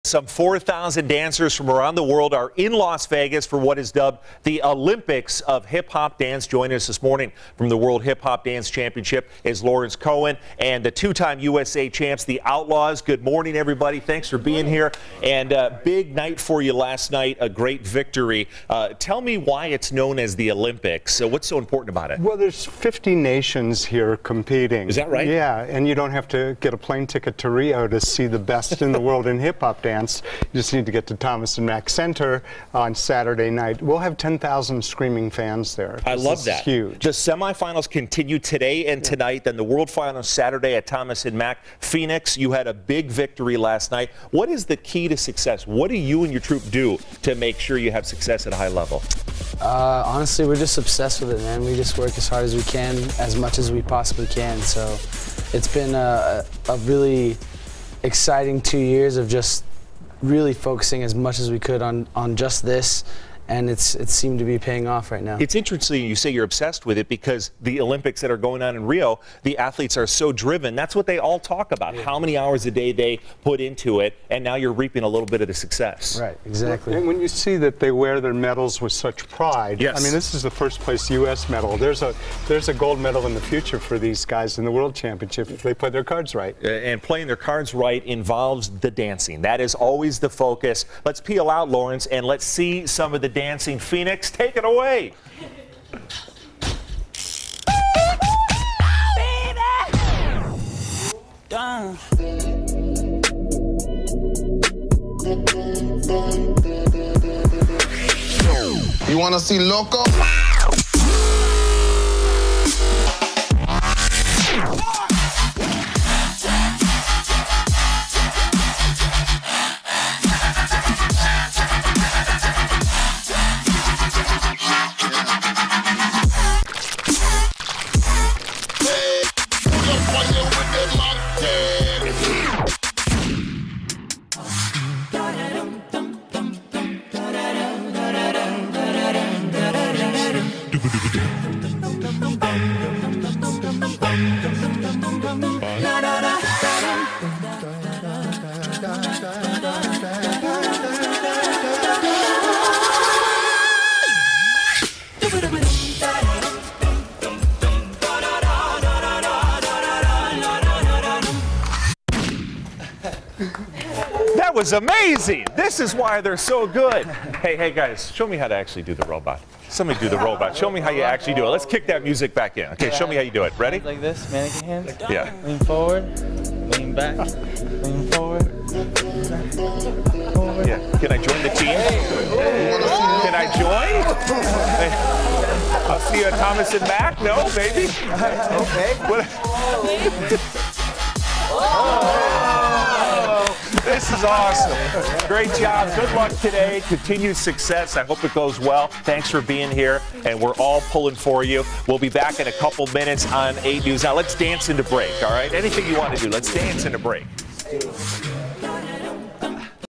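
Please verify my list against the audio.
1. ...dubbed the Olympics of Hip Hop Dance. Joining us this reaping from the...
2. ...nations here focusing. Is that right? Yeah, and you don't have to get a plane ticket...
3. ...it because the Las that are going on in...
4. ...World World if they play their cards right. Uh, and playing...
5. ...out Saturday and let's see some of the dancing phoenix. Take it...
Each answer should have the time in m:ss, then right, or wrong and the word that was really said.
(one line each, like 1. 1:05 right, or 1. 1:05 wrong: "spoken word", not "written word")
1. 0:03 wrong: "morning", not "reaping"
2. 0:23 wrong: "competing", not "focusing"
3. 1:06 wrong: "Olympics", not "Las"
4. 1:24 wrong: "Championship", not "World"
5. 1:31 wrong: "Lawrence", not "Saturday".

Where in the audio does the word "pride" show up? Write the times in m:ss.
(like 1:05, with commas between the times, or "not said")
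1:19.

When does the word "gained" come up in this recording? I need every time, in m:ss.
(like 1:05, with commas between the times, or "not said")
not said.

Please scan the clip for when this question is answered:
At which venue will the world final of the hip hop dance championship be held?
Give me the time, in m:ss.
0:31.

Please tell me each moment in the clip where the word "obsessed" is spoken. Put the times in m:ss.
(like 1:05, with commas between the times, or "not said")
0:50, 1:06.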